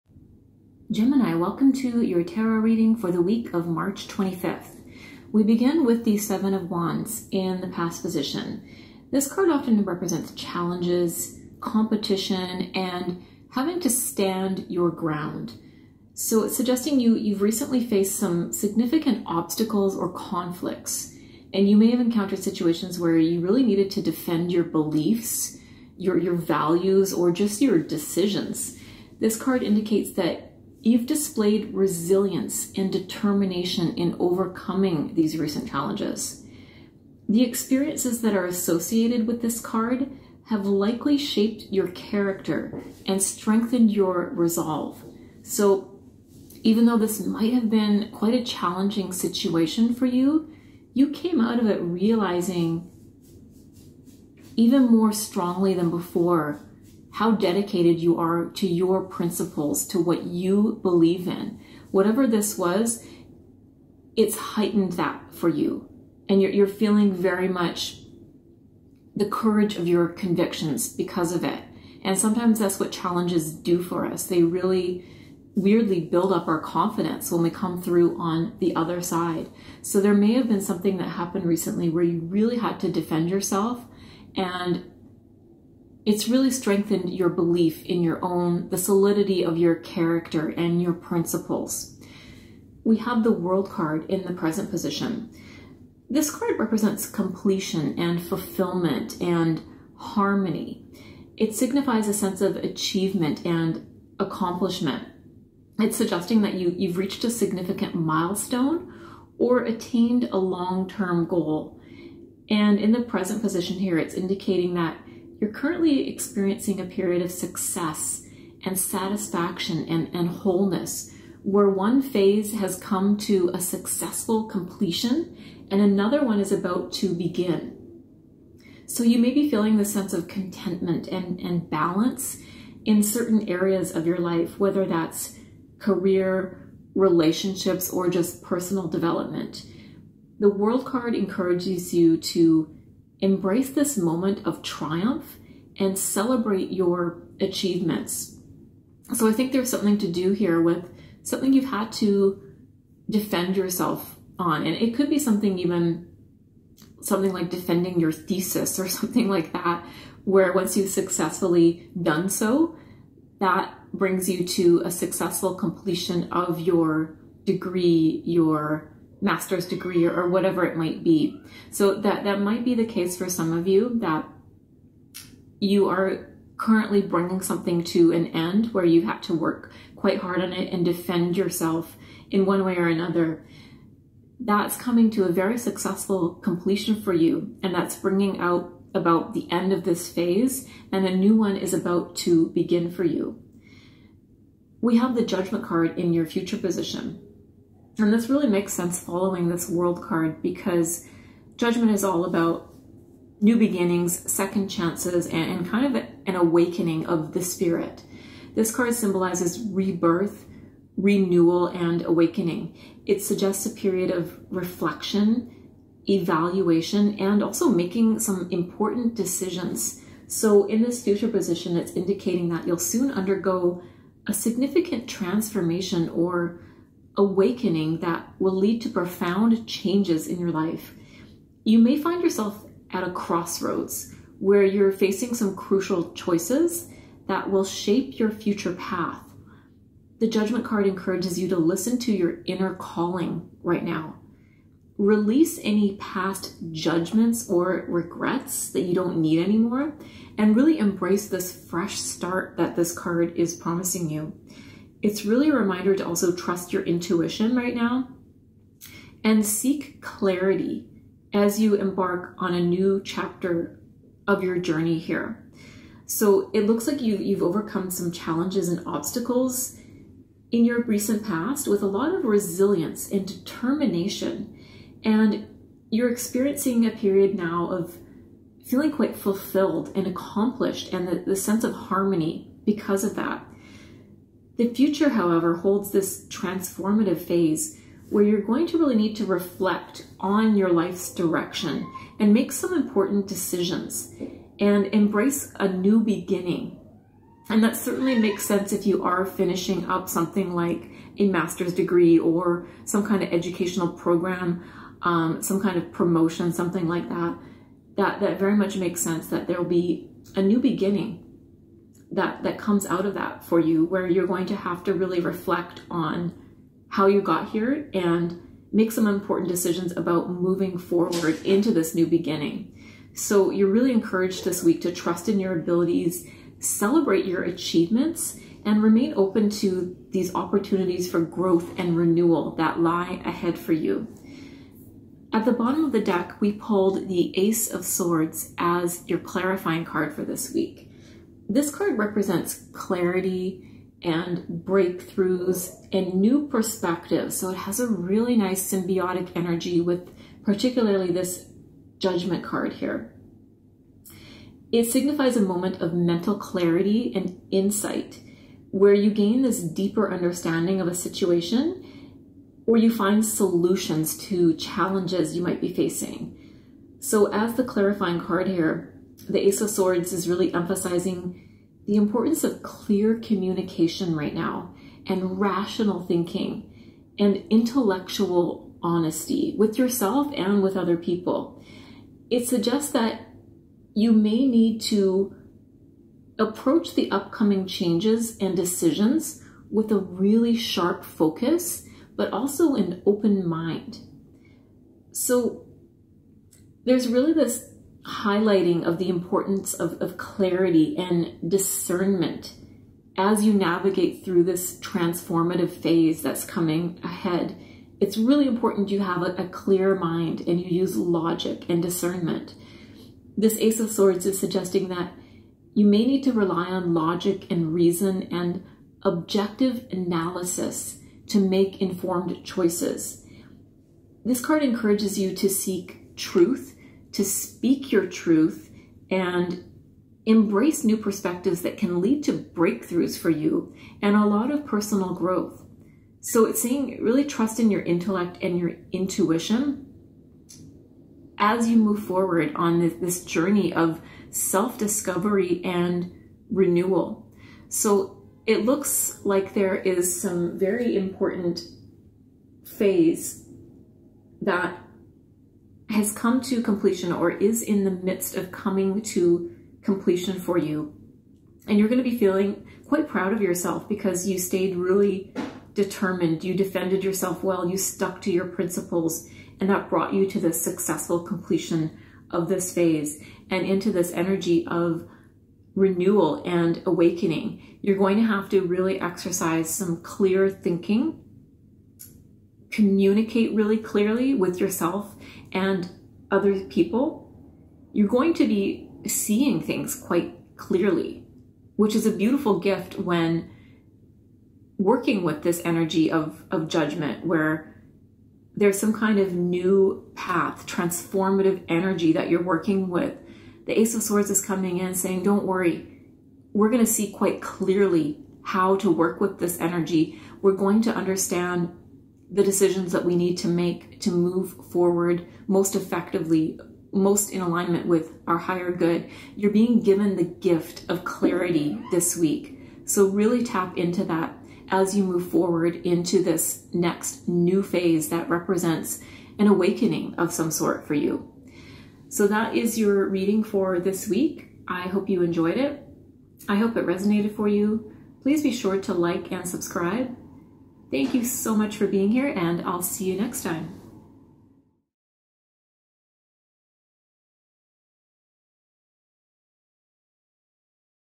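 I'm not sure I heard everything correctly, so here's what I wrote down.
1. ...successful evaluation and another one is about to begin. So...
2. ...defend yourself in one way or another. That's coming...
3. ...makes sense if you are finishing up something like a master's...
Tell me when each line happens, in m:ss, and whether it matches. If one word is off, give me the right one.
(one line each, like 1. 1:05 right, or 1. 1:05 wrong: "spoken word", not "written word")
1. 2:03 wrong: "completion", not "evaluation"
2. 3:00 right
3. 4:58 right.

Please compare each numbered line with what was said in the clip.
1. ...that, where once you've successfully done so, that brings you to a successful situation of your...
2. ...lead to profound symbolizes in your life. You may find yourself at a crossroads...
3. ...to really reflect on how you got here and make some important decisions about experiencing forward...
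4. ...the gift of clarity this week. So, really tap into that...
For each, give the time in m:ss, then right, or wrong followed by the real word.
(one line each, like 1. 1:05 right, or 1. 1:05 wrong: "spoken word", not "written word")
1. 2:39 wrong: "completion", not "situation"
2. 3:48 wrong: "changes", not "symbolizes"
3. 5:14 wrong: "moving", not "experiencing"
4. 8:40 right.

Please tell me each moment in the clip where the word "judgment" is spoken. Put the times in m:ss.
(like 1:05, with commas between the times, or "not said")
3:15, 3:21, 4:00, 4:06, 5:51, 8:16.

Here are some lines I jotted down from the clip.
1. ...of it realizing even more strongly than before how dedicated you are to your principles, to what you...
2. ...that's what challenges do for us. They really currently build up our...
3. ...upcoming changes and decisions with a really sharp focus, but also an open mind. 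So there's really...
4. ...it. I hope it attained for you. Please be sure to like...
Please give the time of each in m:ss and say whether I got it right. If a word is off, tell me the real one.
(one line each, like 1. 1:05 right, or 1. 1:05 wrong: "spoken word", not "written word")
1. 0:51 right
2. 1:12 wrong: "weirdly", not "currently"
3. 6:27 right
4. 8:55 wrong: "resonated", not "attained".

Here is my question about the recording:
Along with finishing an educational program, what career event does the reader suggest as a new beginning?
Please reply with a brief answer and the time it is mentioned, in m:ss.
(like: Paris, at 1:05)
Promotion, at 5:05.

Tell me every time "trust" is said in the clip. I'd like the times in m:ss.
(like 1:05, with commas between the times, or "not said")
4:16, 5:24, 7:17.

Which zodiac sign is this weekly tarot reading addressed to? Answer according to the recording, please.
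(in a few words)
Gemini.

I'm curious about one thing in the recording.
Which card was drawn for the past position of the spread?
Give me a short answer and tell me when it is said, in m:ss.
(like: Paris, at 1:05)
Seven of Wands, at 0:06.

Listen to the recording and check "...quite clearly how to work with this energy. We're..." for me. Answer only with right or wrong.
right.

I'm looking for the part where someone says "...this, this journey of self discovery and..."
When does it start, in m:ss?
7:22.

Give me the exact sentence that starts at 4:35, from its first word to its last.
And you're experiencing a period now of feeling quite fulfilled and accomplished and the, the sense of harmony because of that.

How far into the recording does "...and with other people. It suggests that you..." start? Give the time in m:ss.
6:20.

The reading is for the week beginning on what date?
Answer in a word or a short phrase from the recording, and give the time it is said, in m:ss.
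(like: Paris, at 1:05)
March 25th, at 0:03.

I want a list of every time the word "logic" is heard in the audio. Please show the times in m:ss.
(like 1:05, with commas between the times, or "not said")
6:50, 6:56.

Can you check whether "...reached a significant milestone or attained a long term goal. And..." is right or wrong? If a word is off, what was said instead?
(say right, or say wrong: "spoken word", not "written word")
right.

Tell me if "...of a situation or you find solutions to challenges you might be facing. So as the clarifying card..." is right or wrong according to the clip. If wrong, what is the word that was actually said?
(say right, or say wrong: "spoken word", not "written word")
right.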